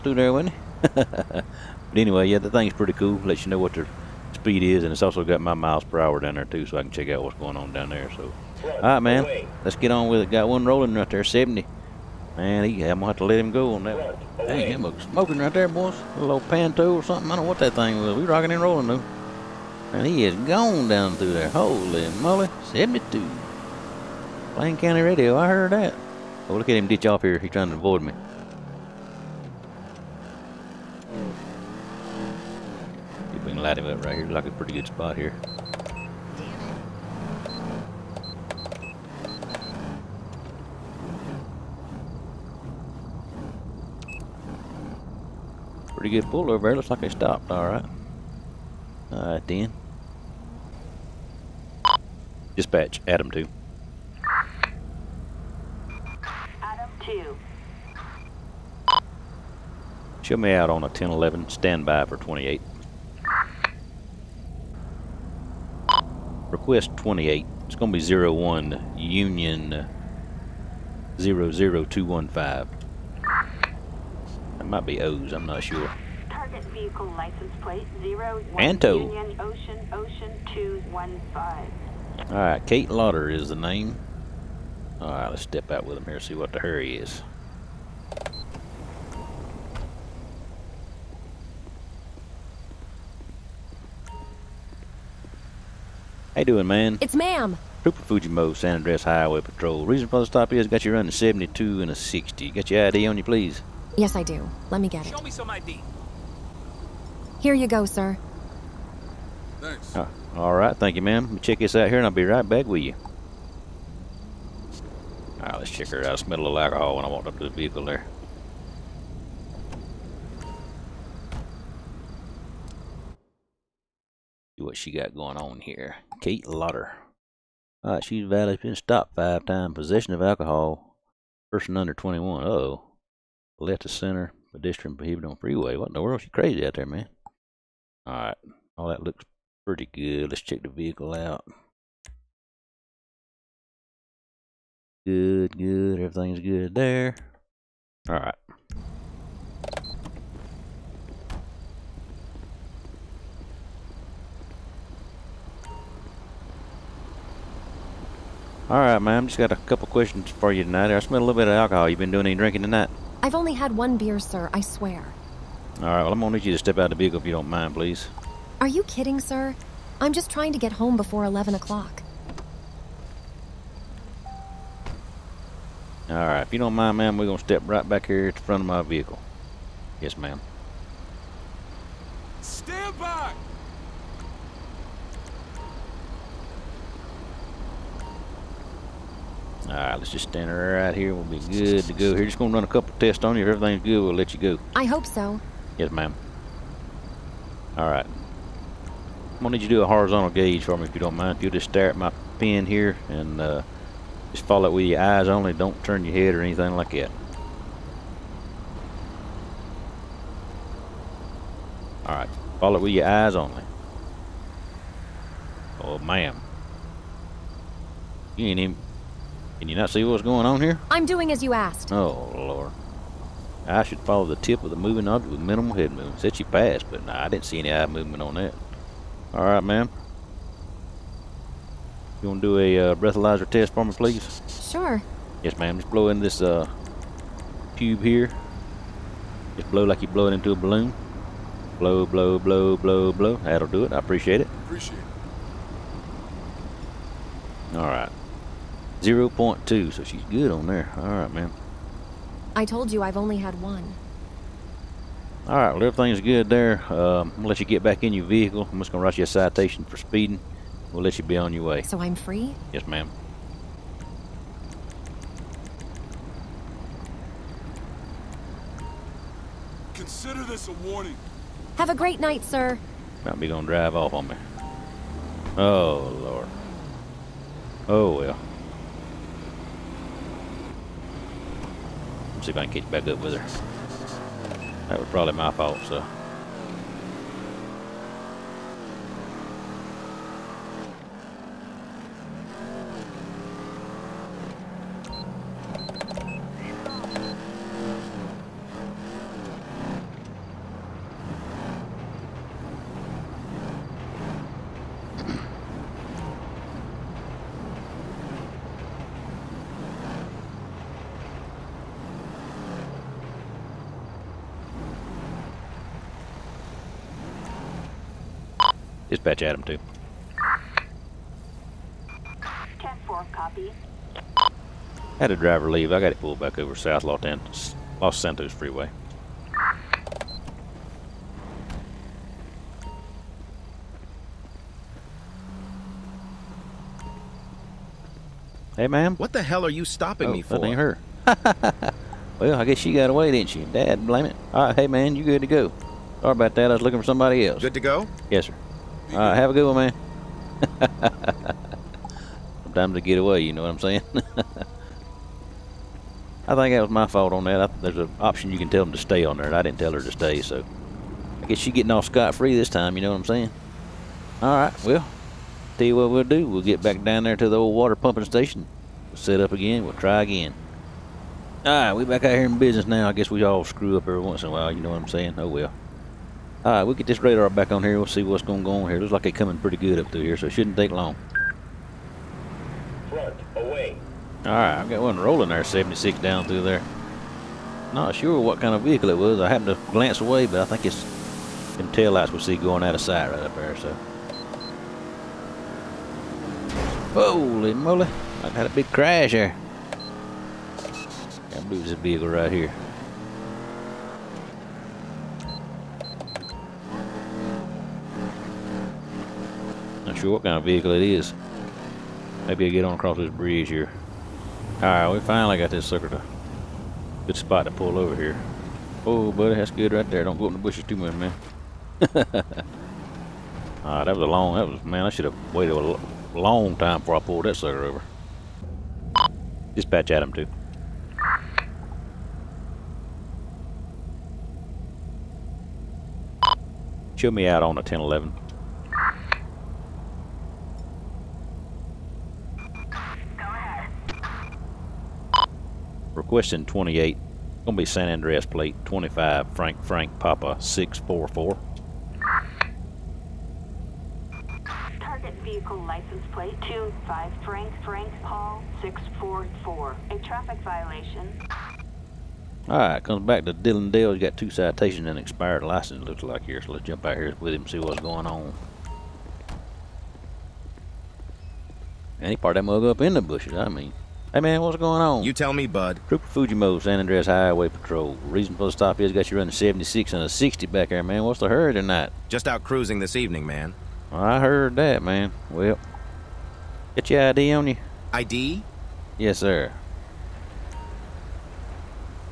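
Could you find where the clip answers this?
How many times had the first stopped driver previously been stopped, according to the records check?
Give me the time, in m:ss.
2:09.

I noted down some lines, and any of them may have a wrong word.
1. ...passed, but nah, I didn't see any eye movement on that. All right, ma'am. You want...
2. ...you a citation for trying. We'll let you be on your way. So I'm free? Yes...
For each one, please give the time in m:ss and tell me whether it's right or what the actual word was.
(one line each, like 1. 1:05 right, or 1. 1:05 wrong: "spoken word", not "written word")
1. 3:46 right
2. 4:19 wrong: "speeding", not "trying".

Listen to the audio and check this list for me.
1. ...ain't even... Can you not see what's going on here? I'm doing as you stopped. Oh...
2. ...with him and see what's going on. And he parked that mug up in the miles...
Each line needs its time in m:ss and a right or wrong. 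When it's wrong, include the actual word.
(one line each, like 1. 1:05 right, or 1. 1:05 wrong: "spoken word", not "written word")
1. 3:38 wrong: "asked", not "stopped"
2. 7:47 wrong: "bushes", not "miles".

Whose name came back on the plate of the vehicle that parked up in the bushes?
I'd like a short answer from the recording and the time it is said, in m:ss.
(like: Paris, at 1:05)
Dylan Dale, at 7:43.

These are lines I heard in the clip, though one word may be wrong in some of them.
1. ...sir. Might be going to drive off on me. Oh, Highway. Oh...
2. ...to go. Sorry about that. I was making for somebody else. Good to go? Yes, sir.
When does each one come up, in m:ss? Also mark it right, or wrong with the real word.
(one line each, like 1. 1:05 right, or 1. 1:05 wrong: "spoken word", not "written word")
1. 4:32 wrong: "Lord", not "Highway"
2. 5:45 wrong: "looking", not "making".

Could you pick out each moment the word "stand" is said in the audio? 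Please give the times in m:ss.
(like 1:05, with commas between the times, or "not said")
1:01, 3:02, 3:10.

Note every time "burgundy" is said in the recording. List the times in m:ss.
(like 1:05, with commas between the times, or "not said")
not said.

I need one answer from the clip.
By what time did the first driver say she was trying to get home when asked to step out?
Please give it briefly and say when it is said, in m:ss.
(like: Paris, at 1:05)
11 o'clock, at 2:51.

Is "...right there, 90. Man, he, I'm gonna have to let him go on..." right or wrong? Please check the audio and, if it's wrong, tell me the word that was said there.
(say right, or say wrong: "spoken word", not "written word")
wrong: "70", not "90".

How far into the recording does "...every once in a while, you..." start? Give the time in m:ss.
6:14.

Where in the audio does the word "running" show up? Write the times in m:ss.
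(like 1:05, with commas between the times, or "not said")
1:40, 7:59.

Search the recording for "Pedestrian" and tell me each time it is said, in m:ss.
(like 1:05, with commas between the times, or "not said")
2:14.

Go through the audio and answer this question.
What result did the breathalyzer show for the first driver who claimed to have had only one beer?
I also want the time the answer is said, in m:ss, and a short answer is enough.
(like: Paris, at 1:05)
0.2, at 4:08.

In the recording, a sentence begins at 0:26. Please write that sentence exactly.
Oh, look at him ditch off here.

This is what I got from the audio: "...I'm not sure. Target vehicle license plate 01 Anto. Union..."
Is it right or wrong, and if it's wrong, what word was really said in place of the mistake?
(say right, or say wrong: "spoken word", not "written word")
right.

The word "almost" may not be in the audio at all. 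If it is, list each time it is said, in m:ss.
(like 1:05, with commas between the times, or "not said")
not said.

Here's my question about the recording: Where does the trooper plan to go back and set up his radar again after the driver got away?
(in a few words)
the old water pumping station.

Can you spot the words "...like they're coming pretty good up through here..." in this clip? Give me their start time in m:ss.
6:19.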